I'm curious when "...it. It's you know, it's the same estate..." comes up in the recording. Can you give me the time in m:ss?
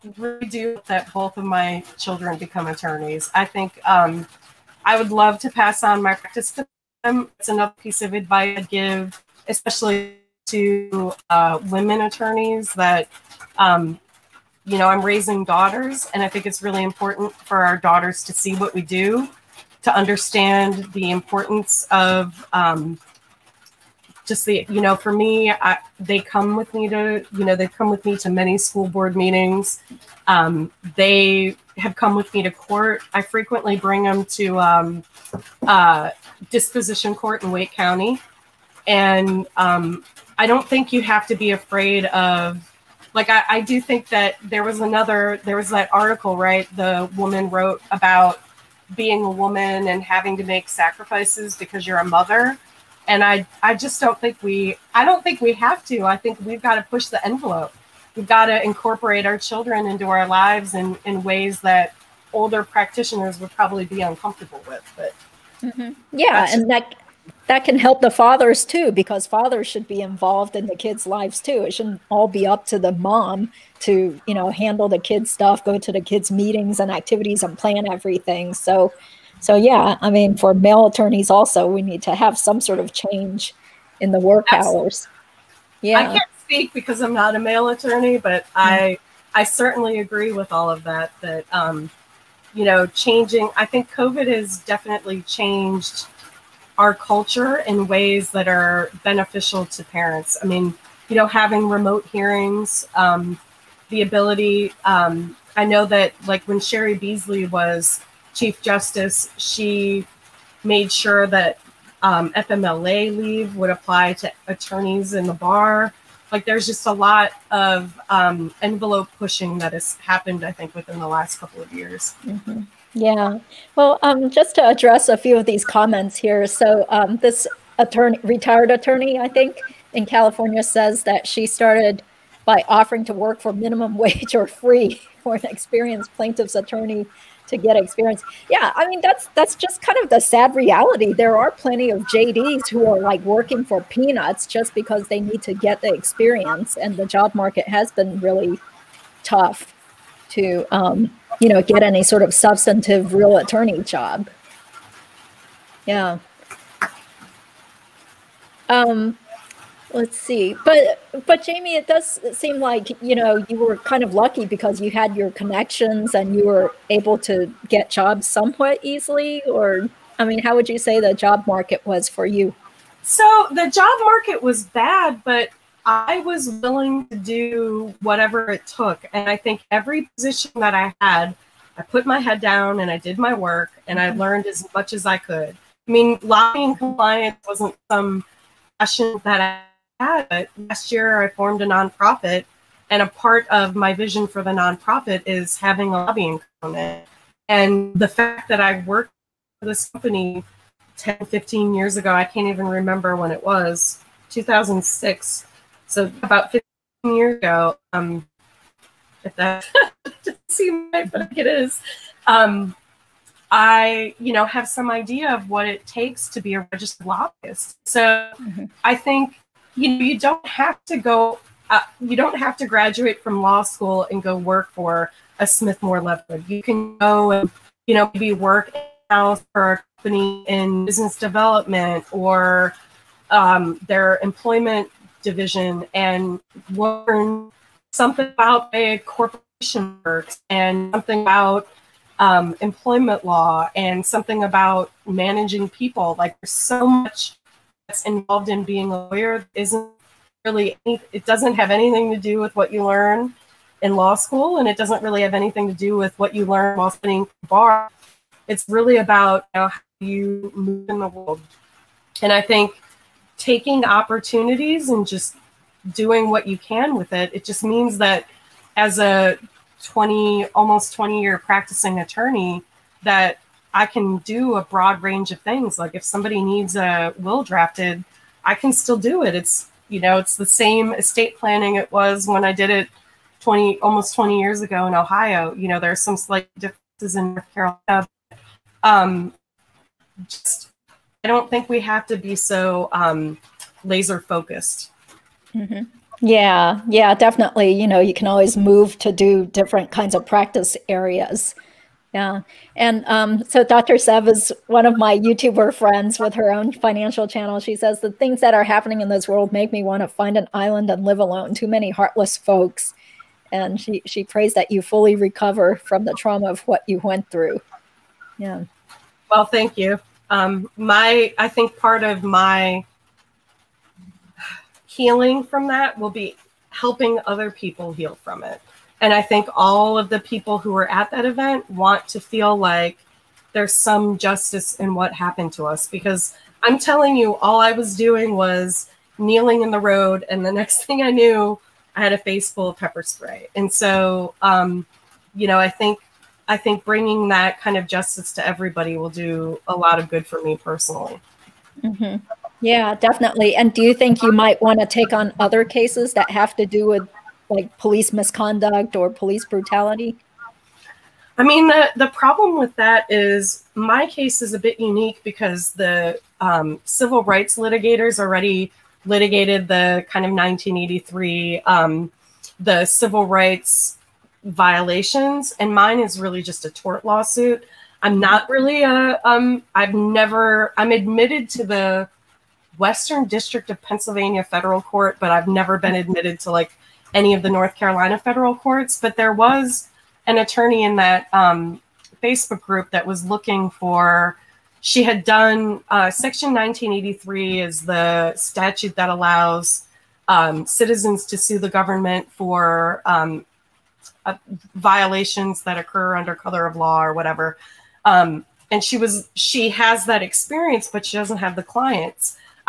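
4:39.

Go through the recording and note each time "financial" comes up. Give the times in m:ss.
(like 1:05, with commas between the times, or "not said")
5:06.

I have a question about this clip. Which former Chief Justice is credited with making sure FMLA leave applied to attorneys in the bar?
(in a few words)
Cheri Beasley.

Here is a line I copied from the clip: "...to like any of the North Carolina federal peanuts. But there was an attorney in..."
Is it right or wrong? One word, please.
wrong.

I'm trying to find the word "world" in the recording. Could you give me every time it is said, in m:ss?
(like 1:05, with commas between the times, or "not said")
4:21, 5:09.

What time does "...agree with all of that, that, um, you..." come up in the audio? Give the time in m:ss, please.
1:29.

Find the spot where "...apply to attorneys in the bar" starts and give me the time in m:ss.
1:53.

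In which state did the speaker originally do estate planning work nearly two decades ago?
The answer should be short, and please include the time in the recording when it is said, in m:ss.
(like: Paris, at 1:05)
Ohio, at 4:44.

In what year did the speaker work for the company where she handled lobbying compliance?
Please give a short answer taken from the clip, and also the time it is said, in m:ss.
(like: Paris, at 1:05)
2006, at 3:24.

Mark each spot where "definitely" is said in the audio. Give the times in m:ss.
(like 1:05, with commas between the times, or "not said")
1:34, 4:57, 5:52.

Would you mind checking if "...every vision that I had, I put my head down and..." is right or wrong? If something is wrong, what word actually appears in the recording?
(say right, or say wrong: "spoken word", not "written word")
wrong: "position", not "vision".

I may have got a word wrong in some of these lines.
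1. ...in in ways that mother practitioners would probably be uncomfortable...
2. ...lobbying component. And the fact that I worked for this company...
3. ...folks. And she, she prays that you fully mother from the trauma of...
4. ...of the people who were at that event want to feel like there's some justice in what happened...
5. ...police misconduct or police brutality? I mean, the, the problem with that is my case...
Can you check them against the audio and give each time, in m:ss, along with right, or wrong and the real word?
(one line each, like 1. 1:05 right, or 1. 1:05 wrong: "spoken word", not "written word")
1. 1:00 wrong: "older", not "mother"
2. 3:16 right
3. 5:12 wrong: "recover", not "mother"
4. 5:29 right
5. 5:57 right.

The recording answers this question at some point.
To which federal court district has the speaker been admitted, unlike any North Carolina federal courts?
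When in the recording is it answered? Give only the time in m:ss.
6:22.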